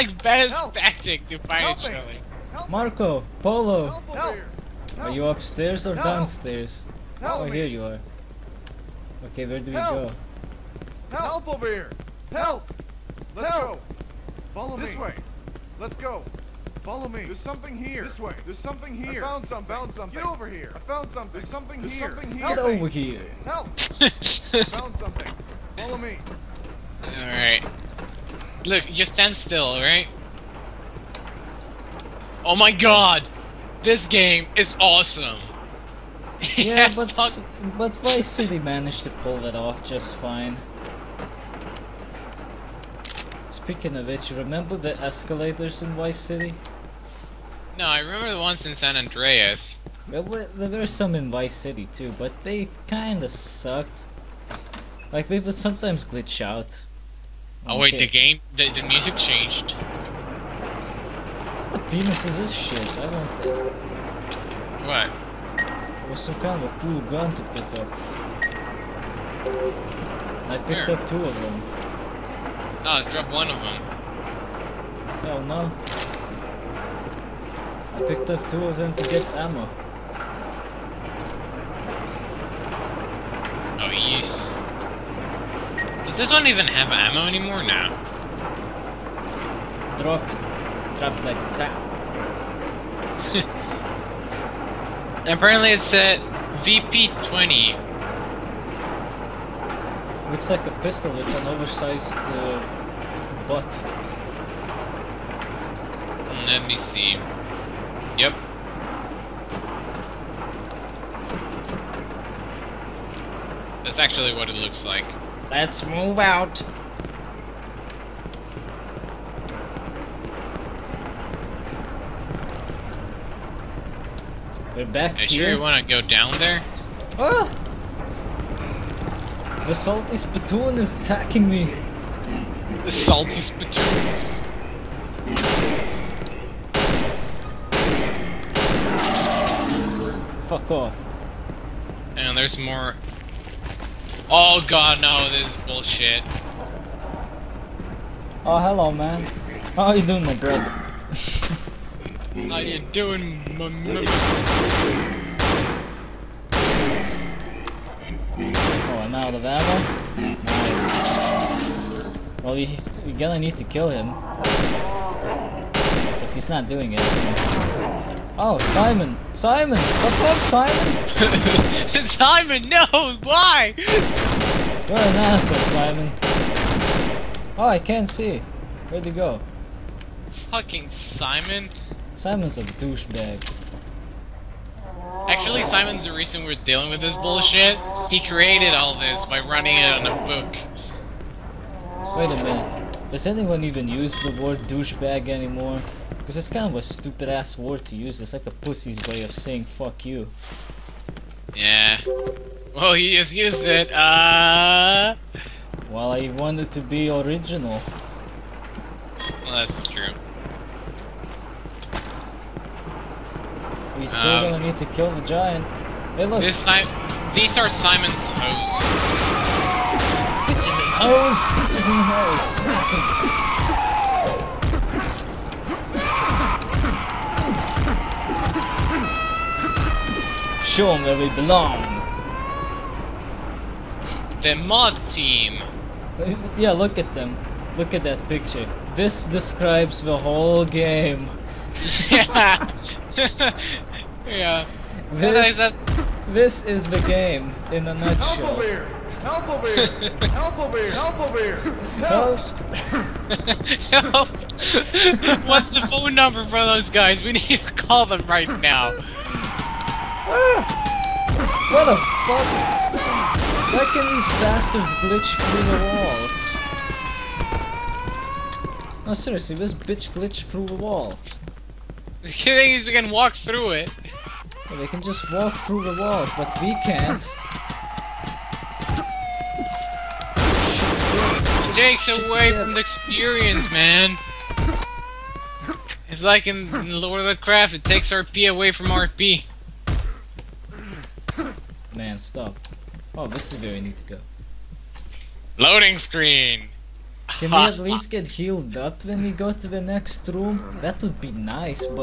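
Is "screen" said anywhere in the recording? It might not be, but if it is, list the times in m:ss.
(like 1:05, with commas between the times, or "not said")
4:55.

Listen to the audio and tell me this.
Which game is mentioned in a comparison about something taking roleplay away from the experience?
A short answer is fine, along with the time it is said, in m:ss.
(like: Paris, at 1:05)
Lord of the Craft, at 4:47.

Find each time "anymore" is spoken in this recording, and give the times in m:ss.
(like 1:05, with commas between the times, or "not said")
1:27, 3:15.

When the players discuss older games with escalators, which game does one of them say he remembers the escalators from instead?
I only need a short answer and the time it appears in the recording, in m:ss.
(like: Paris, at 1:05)
San Andreas, at 0:48.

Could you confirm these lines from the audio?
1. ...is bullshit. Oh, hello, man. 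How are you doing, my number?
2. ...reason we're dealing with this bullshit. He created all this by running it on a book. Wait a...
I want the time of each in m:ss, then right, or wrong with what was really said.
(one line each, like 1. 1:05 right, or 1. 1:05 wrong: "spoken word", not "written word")
1. 2:25 wrong: "brother", not "number"
2. 3:06 right.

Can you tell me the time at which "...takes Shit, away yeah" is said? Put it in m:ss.
4:41.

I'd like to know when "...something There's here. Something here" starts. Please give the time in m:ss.
0:21.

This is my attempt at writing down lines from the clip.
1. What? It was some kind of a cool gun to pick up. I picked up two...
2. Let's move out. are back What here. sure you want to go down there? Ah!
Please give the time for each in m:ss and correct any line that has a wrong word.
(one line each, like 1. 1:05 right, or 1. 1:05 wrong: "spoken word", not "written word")
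1. 1:04 right
2. 1:55 wrong: "Are", not "What".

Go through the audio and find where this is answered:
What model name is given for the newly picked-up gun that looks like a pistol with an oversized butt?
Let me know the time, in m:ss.
1:36.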